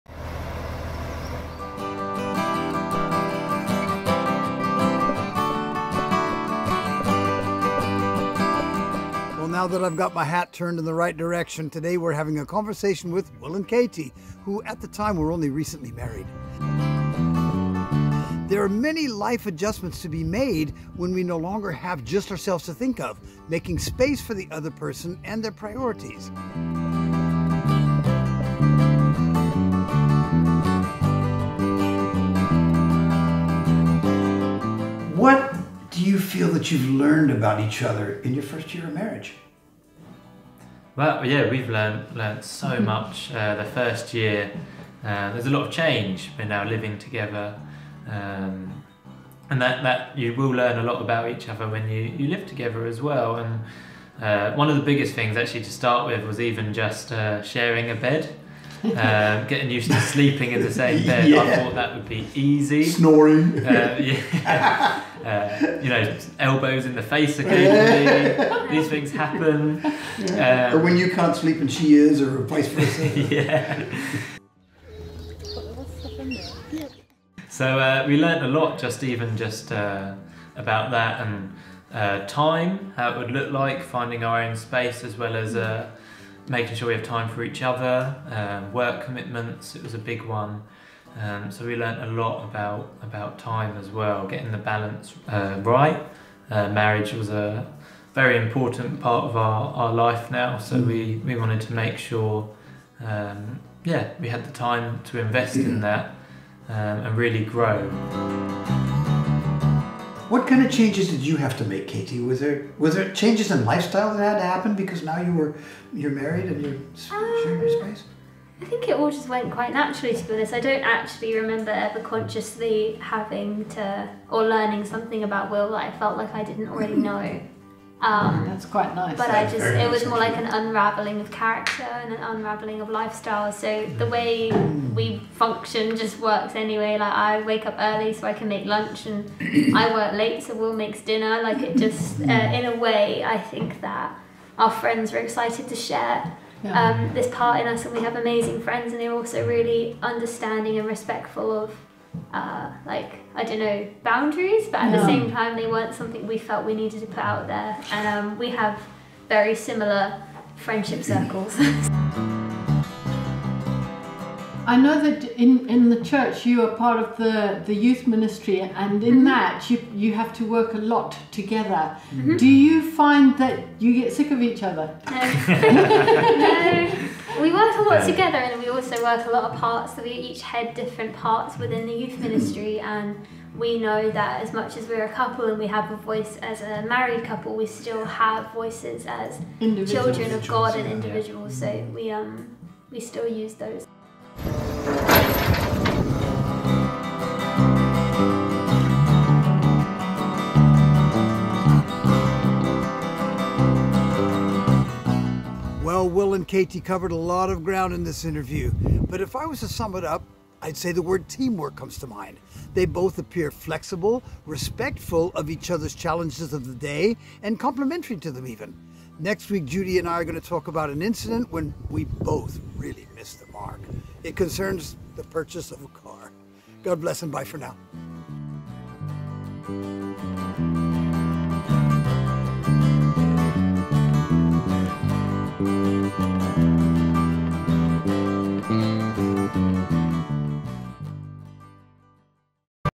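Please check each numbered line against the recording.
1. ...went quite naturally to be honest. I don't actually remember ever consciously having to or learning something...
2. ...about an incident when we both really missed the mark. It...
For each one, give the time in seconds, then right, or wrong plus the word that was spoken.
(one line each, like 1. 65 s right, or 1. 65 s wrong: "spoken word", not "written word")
1. 119 s right
2. 220 s right.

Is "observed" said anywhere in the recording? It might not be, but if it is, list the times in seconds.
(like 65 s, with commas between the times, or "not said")
not said.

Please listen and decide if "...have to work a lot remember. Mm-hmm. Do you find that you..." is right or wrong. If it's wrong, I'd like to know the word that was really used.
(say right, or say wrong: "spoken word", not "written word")
wrong: "together", not "remember".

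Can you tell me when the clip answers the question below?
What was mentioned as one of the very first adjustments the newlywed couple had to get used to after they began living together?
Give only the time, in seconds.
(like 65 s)
57 s.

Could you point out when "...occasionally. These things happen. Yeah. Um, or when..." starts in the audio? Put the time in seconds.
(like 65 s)
67 s.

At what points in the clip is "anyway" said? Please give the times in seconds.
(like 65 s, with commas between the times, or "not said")
136 s.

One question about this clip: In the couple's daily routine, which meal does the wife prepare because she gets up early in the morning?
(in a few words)
lunch.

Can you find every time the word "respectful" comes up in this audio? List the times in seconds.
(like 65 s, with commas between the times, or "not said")
150 s, 214 s.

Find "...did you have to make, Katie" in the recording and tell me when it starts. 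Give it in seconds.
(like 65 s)
111 s.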